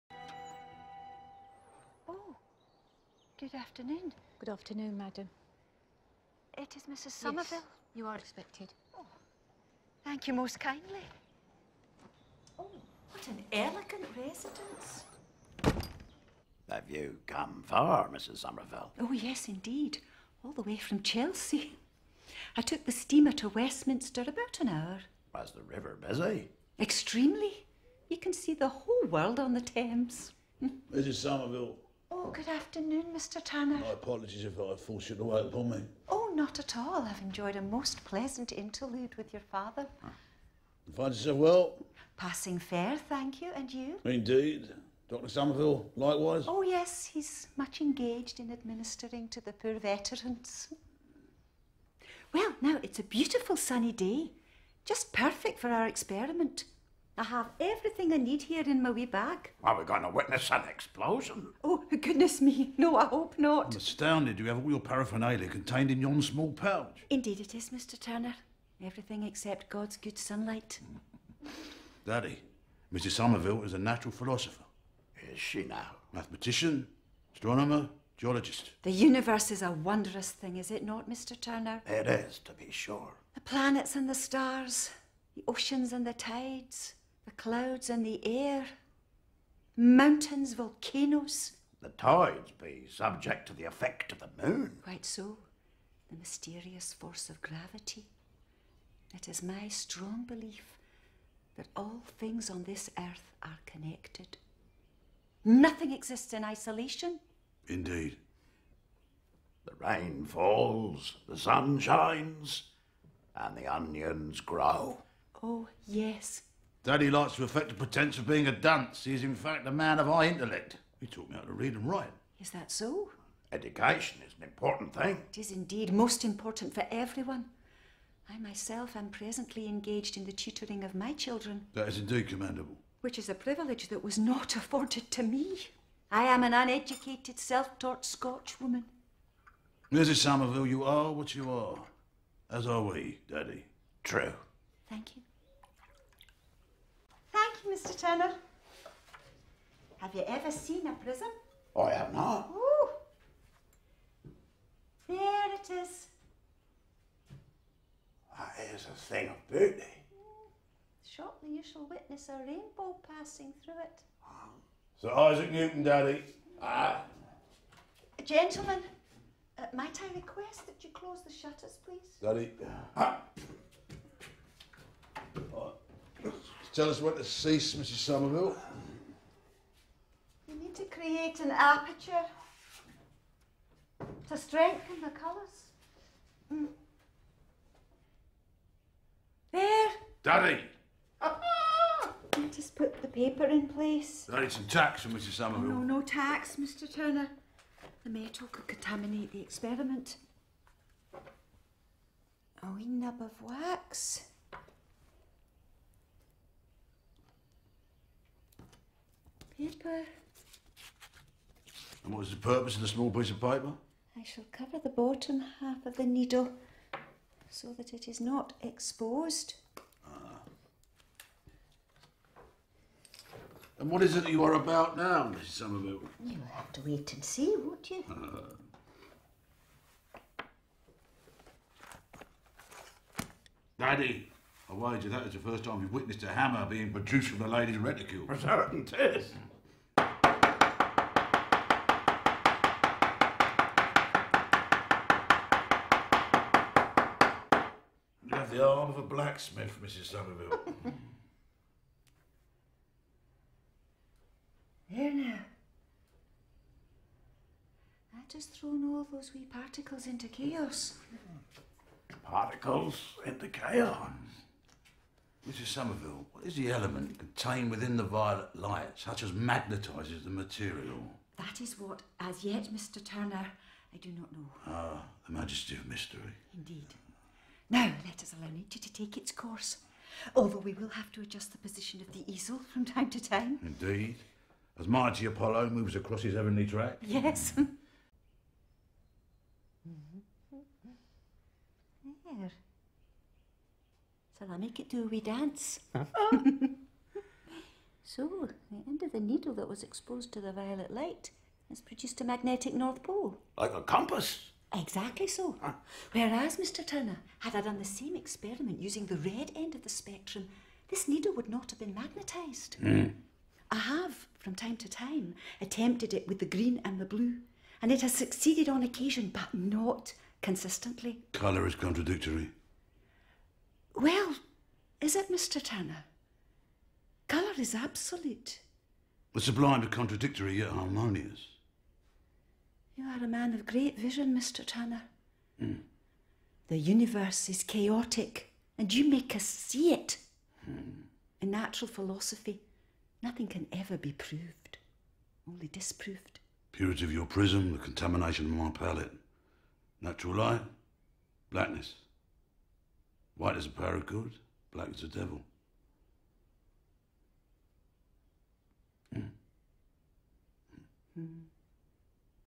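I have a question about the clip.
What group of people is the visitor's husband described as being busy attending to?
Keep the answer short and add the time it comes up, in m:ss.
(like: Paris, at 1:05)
Poor veterans, at 0:49.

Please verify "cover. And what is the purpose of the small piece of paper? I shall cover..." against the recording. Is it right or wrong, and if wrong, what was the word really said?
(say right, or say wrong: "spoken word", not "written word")
wrong: "paper", not "cover".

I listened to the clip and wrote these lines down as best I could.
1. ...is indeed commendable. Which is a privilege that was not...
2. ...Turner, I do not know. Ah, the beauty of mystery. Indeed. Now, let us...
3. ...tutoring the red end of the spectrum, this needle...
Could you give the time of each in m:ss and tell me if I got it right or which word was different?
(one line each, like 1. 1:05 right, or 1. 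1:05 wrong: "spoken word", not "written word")
1. 2:11 right
2. 4:33 wrong: "majesty", not "beauty"
3. 5:08 wrong: "using", not "tutoring".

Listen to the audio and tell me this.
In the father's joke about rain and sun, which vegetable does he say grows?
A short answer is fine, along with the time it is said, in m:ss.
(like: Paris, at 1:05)
Onions, at 1:53.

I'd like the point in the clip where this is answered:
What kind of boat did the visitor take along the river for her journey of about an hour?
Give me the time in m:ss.
0:22.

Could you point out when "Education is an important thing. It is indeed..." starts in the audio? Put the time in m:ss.
2:03.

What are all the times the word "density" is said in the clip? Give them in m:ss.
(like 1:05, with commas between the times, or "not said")
not said.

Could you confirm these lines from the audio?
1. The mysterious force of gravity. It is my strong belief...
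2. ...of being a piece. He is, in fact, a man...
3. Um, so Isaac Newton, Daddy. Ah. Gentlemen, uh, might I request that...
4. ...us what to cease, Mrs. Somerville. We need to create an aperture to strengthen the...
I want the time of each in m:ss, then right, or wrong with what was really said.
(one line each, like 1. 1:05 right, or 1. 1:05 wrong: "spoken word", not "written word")
1. 1:36 right
2. 1:58 wrong: "dunce", not "piece"
3. 2:44 right
4. 2:56 right.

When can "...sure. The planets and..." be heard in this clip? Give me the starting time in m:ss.
1:22.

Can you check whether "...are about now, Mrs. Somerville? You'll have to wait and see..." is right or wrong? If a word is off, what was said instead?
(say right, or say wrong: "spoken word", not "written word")
right.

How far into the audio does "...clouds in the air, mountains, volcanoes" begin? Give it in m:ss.
1:27.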